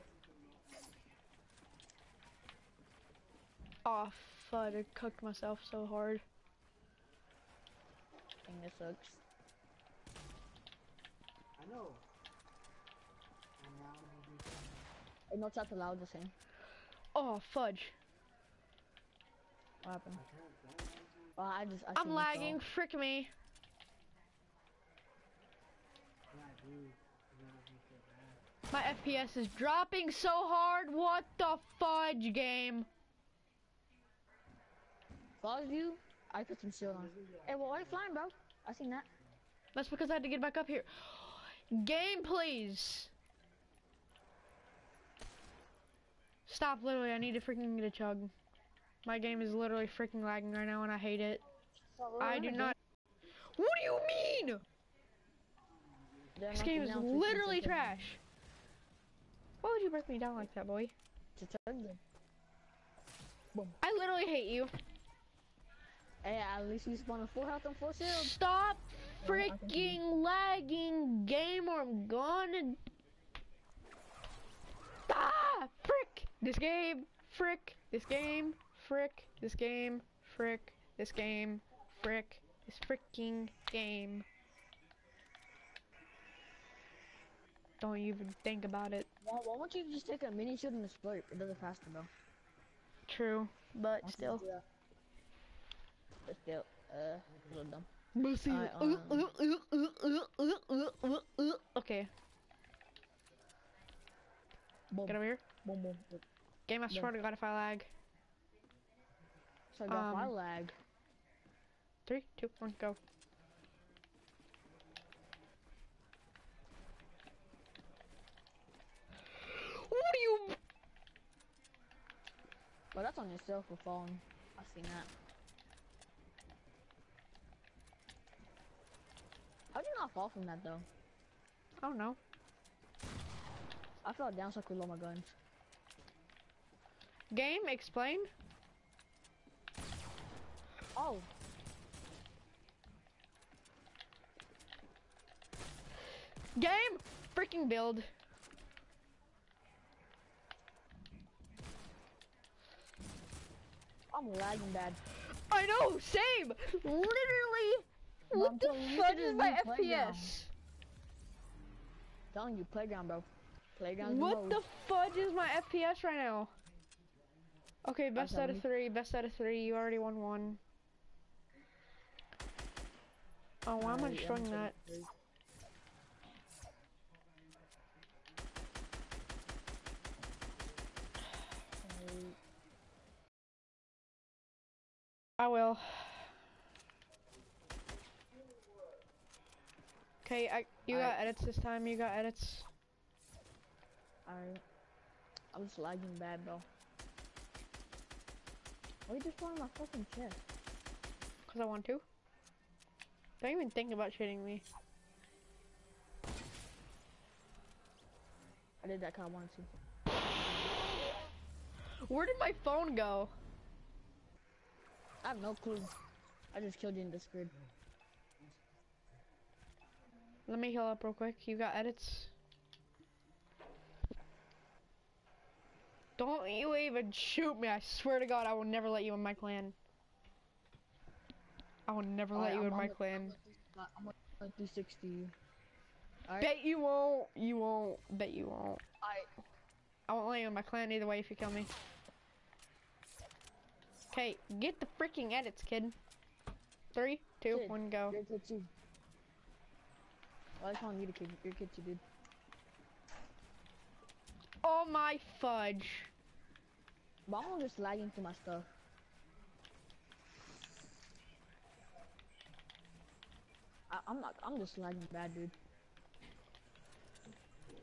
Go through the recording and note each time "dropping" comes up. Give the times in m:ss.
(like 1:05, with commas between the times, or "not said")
0:29.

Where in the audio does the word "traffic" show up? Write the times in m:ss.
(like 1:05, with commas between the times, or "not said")
not said.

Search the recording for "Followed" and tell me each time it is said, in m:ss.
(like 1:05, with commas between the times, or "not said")
0:35.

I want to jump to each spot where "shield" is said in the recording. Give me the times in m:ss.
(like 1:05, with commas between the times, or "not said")
1:07, 1:30.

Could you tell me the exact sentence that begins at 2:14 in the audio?
I fell down so I could load my guns.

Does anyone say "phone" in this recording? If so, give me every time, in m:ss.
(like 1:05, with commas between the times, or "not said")
2:03, 3:32.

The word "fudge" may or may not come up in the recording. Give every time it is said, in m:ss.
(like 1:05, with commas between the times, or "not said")
0:17, 0:31, 2:44, 4:15.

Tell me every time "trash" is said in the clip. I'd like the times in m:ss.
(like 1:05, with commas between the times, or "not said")
0:57.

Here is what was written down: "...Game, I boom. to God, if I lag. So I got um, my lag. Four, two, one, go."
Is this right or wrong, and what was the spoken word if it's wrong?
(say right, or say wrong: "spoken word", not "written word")
wrong: "Three", not "Four".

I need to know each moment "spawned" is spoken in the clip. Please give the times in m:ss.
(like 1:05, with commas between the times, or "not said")
1:06.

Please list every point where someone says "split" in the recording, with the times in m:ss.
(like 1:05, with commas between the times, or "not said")
1:30.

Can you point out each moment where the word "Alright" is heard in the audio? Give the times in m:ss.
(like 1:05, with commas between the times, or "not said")
3:14.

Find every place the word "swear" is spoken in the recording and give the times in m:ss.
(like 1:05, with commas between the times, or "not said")
3:47.